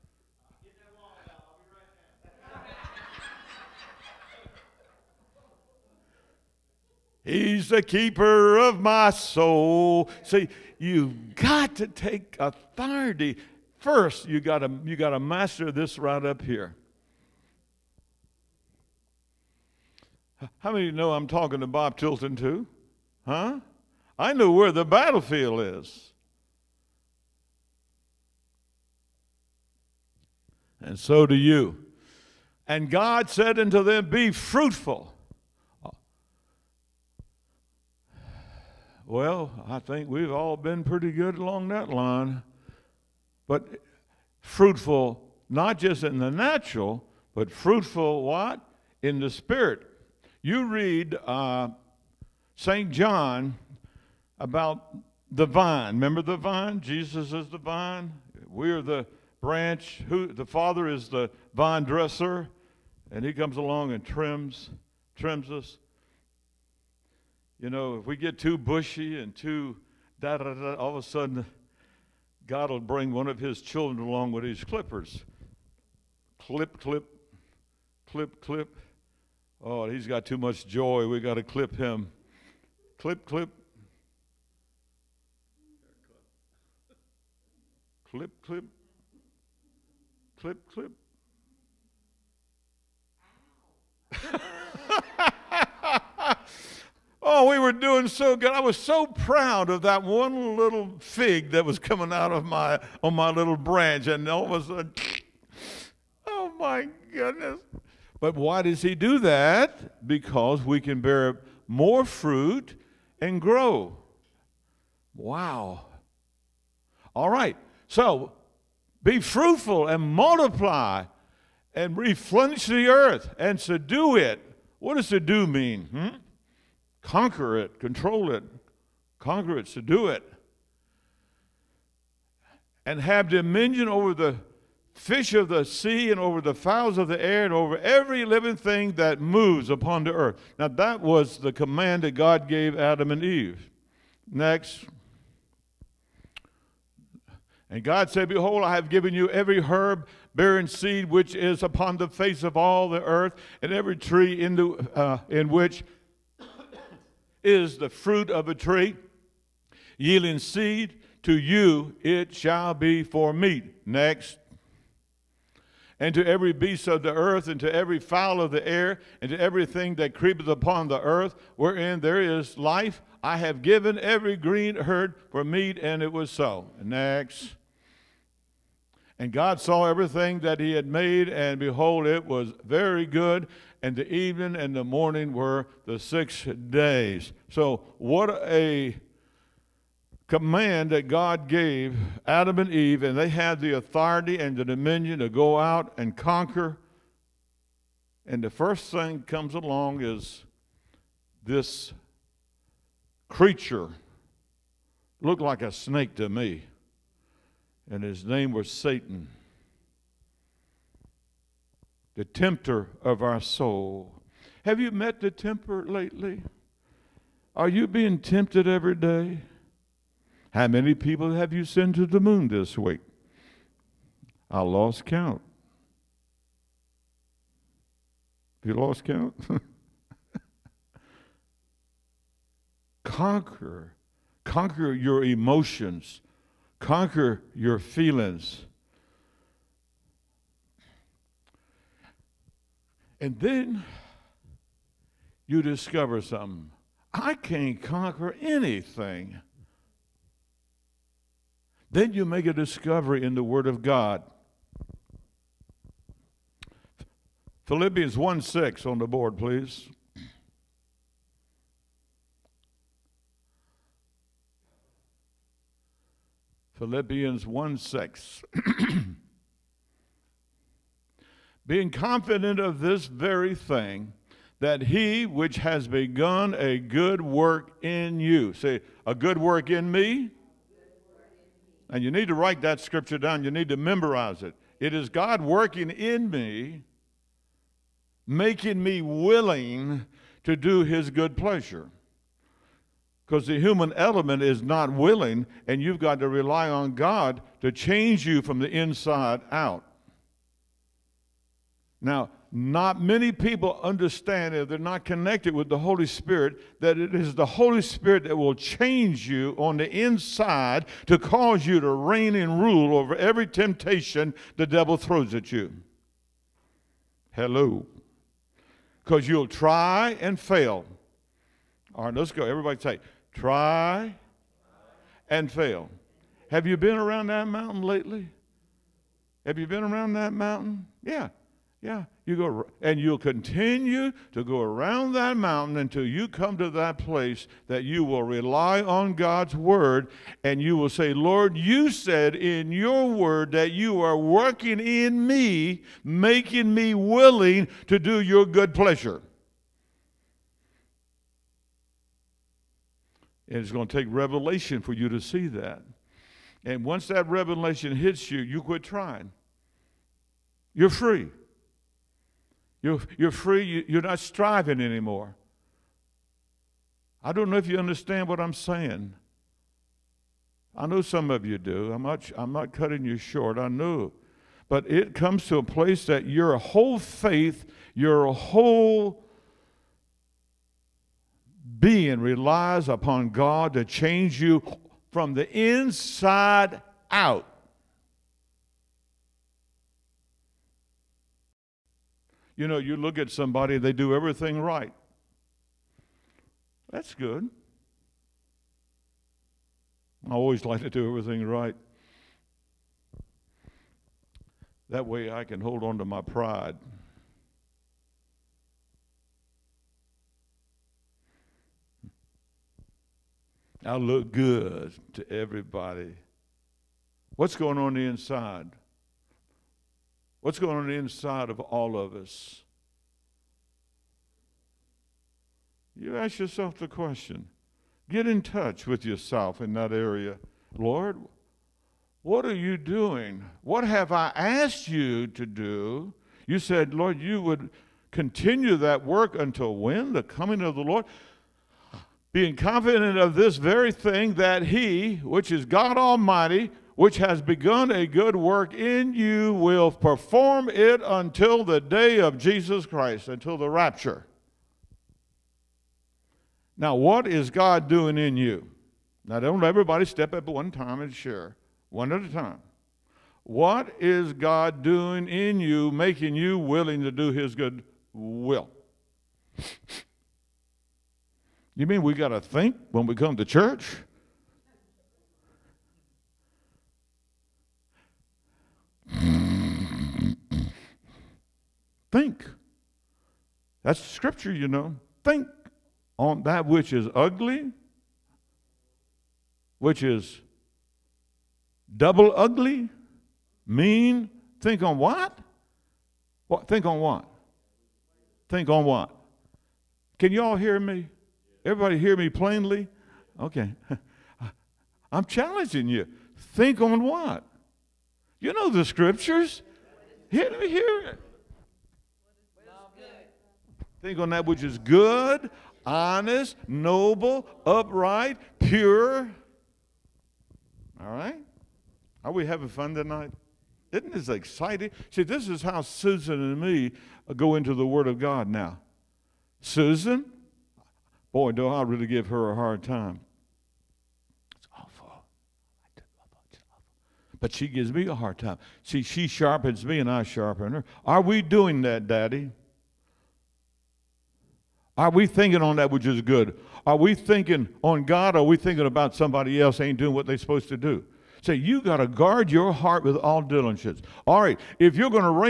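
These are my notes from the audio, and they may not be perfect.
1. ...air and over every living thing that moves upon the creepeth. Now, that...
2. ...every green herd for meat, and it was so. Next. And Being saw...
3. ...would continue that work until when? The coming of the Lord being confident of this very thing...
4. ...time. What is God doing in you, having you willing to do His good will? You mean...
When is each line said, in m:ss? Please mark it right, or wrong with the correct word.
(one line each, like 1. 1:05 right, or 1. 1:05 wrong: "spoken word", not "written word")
1. 2:17 wrong: "earth", not "creepeth"
2. 2:53 wrong: "God", not "Being"
3. 7:17 right
4. 7:42 wrong: "making", not "having".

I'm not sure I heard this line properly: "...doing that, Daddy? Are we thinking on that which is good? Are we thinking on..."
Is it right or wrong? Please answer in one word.
right.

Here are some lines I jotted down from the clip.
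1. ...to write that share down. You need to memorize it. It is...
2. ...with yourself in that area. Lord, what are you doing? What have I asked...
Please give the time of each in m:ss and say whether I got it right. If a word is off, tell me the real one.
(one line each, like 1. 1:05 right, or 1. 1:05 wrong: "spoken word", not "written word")
1. 4:42 wrong: "scripture", not "share"
2. 7:08 right.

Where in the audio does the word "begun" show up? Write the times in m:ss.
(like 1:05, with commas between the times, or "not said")
4:35, 7:27.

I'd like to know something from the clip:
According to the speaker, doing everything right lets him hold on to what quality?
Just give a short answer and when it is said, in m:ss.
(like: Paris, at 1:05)
pride, at 6:46.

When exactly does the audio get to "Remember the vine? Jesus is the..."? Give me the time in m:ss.
0:55.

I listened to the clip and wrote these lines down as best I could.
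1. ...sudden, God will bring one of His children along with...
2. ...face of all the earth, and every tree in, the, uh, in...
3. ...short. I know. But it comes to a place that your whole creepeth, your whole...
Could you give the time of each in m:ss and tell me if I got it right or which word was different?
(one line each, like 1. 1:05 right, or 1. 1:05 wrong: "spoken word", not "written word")
1. 1:11 right
2. 2:32 right
3. 6:13 wrong: "faith", not "creepeth".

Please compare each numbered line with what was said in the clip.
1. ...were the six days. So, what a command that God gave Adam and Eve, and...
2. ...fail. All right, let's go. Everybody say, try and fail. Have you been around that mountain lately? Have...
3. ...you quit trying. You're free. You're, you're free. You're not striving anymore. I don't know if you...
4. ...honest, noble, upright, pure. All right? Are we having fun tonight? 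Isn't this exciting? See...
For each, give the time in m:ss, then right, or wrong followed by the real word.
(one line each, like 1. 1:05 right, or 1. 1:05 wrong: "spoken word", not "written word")
1. 3:05 right
2. 5:20 right
3. 5:58 right
4. 8:35 right.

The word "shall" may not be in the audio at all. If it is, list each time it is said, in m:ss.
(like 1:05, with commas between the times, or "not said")
2:42.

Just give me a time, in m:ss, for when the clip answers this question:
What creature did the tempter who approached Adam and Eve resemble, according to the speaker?
3:25.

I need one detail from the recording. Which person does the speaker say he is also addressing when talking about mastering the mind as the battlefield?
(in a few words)
Bob Tilton.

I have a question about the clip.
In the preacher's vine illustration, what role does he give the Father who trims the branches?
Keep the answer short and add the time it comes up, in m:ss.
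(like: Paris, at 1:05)
the vine dresser, at 1:01.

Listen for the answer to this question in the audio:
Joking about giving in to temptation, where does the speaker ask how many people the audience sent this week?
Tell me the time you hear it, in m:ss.
3:42.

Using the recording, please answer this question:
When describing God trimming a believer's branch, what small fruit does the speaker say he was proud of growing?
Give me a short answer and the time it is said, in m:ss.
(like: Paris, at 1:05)
fig, at 1:40.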